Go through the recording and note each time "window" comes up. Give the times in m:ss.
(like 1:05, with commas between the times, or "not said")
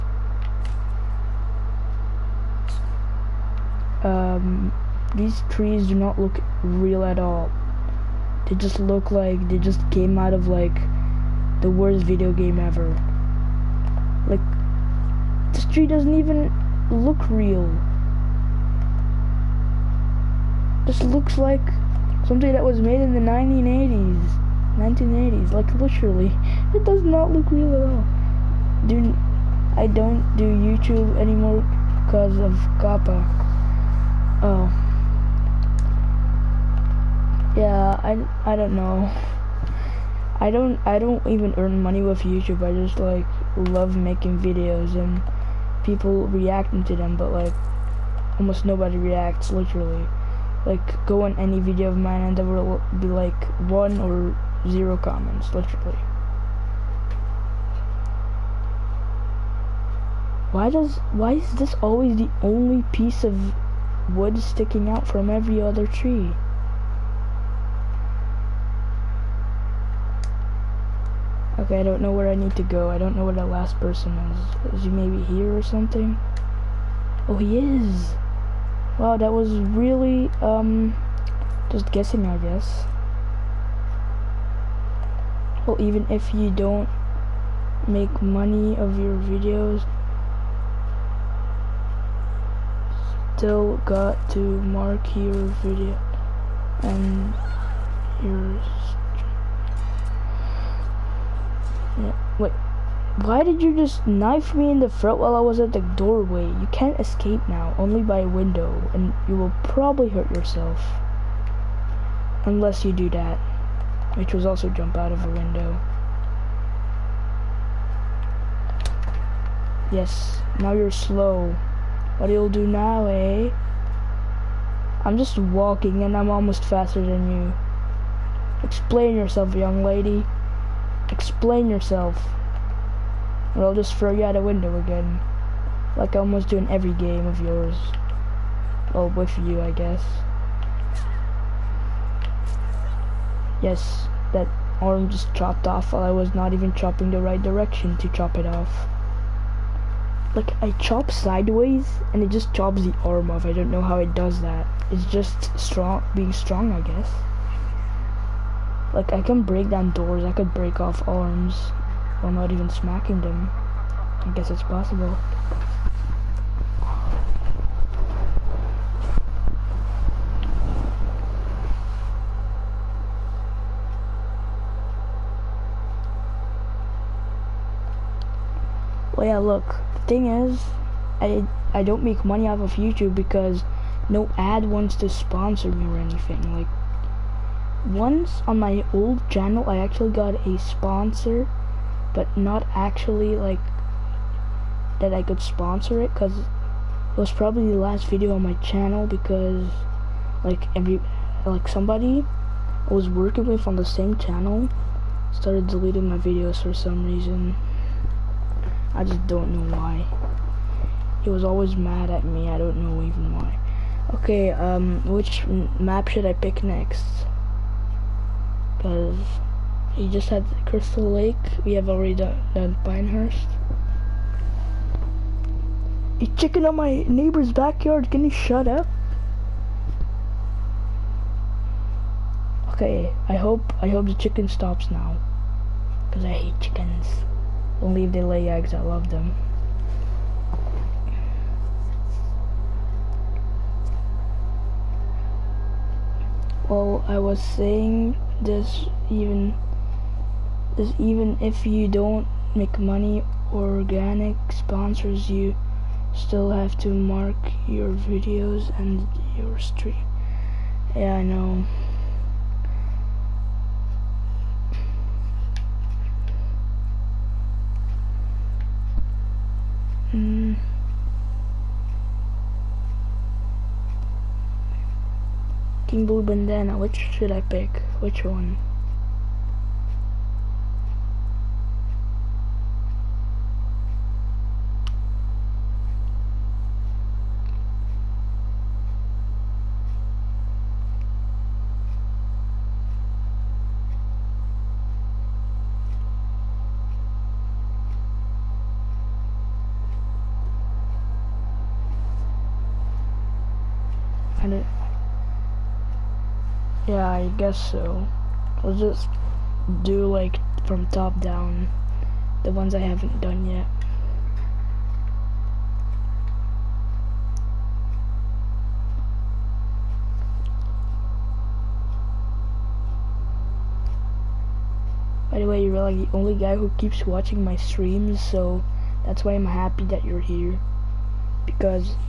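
1:48, 1:55, 2:14.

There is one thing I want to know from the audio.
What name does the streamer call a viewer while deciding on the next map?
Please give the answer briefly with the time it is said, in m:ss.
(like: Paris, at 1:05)
King Blue Bandana, at 4:35.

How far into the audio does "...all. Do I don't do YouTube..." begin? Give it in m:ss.
0:27.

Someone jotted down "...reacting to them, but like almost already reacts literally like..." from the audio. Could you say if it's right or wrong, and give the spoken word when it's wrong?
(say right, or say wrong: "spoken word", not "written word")
wrong: "nobody", not "already".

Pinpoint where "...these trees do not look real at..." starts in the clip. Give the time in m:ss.
0:05.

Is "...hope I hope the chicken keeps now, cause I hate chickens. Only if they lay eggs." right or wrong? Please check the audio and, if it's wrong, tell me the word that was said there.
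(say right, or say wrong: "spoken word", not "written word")
wrong: "stops", not "keeps".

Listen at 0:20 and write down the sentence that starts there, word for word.
This looks like something that was made in the 1980s.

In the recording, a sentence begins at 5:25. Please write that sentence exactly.
By the way, you're like the only guy who keeps watching my streams, so that's why I'm happy that you're here.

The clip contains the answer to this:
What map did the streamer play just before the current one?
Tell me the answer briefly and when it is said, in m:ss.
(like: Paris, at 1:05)
Crystal Lake, at 3:40.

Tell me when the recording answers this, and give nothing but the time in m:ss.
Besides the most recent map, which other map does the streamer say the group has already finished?
3:42.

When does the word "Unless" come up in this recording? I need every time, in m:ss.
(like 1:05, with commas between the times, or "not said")
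1:52.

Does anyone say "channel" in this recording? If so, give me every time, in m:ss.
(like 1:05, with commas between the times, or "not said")
3:09, 3:18, 3:24.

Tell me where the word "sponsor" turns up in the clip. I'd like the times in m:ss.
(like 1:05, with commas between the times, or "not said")
3:05, 3:10, 3:15, 4:14.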